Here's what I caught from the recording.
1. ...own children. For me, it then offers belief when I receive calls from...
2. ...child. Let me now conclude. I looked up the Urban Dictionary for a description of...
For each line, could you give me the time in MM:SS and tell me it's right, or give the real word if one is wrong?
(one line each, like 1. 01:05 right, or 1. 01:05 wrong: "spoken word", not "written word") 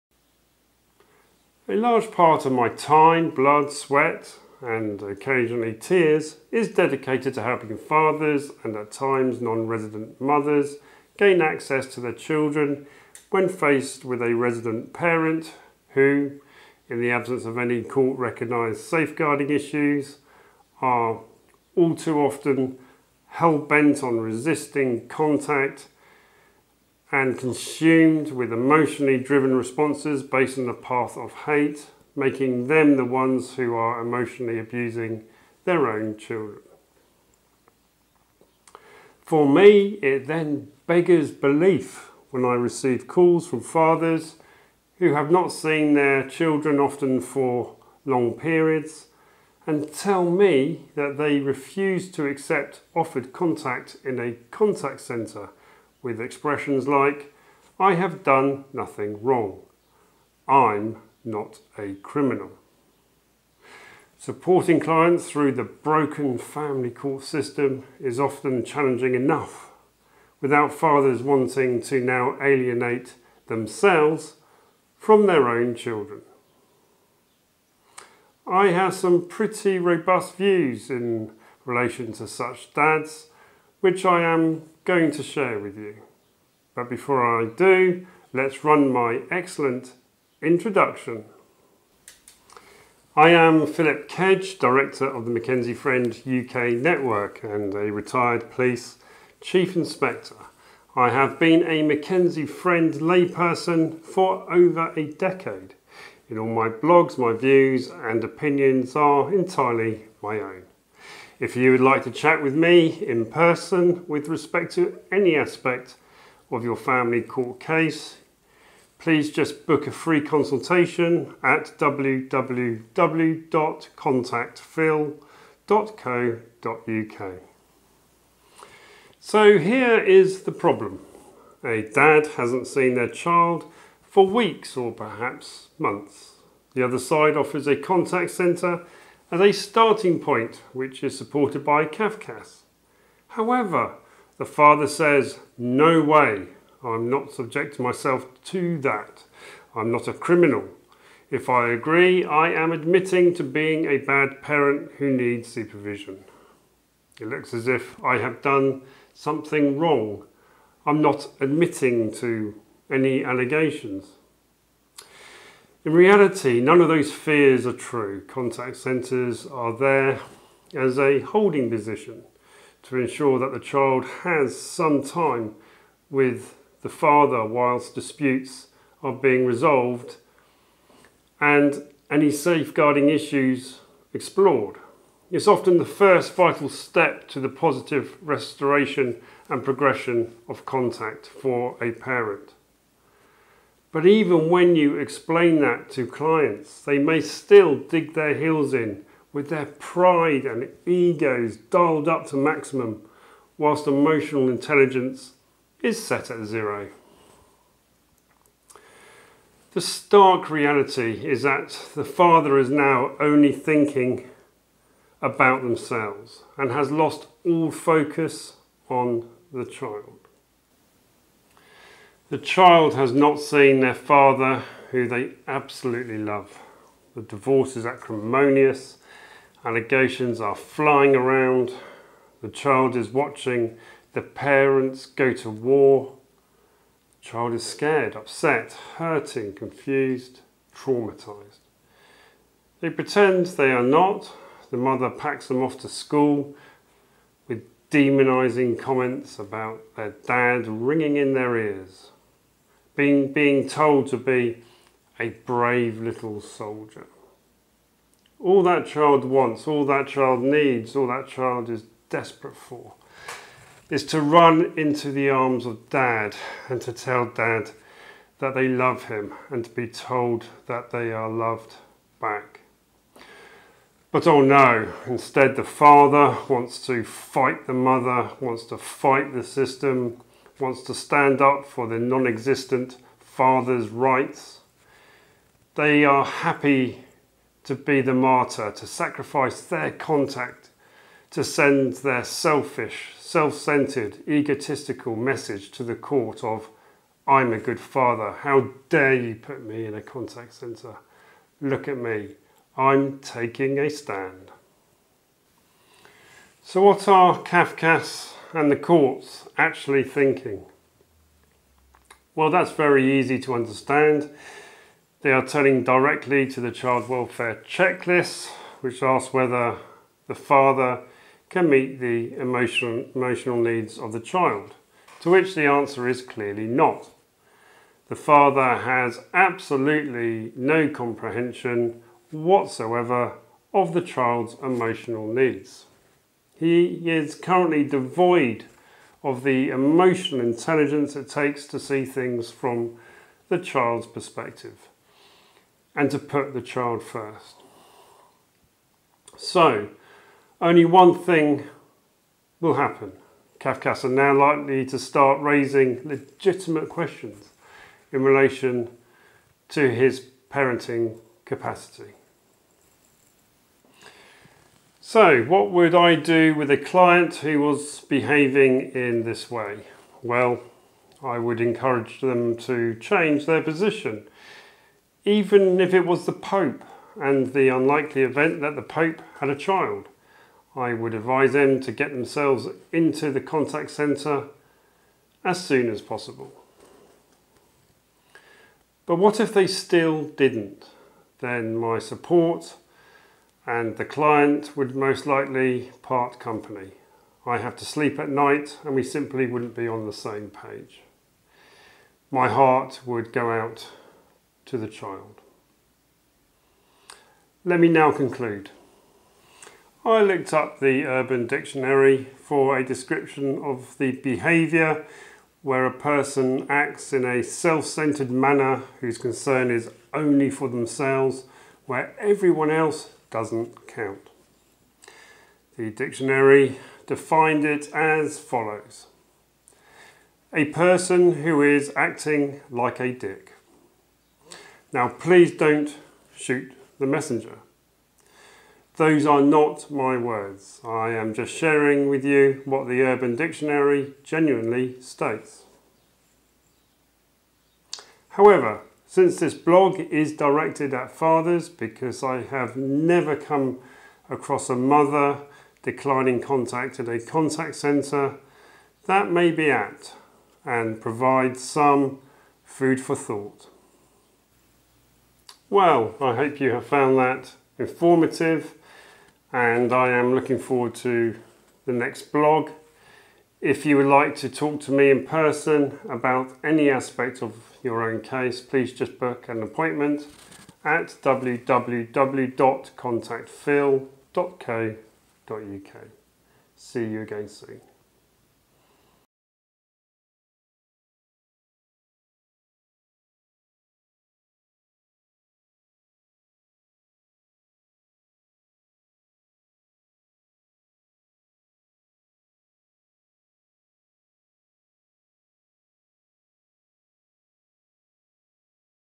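1. 00:35 wrong: "beggars", not "offers"
2. 06:44 right.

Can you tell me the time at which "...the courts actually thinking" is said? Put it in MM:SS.
05:08.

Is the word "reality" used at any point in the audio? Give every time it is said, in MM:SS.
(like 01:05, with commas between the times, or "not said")
02:45, 03:30.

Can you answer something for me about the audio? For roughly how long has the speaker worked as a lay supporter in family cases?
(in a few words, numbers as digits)
over a decade.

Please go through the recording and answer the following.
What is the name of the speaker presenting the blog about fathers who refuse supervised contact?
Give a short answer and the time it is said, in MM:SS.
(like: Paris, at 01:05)
Philip Kedge, at 01:33.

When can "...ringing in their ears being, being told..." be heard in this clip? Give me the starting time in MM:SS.
04:10.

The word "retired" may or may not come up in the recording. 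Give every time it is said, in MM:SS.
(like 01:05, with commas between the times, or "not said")
01:37.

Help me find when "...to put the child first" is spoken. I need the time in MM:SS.
05:46.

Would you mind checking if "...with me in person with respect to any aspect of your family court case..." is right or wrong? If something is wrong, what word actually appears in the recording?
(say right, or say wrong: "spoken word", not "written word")
right.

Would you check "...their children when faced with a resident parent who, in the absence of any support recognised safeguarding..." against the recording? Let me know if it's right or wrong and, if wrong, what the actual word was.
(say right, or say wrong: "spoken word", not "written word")
wrong: "court", not "support".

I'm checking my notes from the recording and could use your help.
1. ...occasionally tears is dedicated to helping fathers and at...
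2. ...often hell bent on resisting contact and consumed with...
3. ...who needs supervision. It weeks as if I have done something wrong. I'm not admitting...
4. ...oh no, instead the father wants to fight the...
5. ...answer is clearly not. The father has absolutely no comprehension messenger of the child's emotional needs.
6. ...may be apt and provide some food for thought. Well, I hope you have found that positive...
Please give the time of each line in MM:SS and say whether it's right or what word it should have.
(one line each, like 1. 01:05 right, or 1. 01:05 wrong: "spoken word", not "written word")
1. 00:05 right
2. 00:22 right
3. 02:34 wrong: "looks", not "weeks"
4. 04:34 right
5. 05:25 wrong: "whatsoever", not "messenger"
6. 07:39 wrong: "informative", not "positive".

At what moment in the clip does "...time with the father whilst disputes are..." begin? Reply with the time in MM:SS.
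02:55.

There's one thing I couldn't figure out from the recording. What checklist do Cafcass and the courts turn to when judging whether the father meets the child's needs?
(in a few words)
child welfare checklist.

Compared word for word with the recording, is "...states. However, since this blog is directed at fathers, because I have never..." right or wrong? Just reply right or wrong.
right.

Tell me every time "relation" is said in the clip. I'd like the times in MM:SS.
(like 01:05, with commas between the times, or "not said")
01:21, 05:58.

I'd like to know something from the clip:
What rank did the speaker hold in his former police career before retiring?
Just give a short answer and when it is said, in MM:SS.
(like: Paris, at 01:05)
Chief Inspector, at 01:39.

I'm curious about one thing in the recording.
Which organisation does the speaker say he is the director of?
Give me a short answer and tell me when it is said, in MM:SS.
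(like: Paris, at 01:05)
McKenzie Friend UK Network, at 01:35.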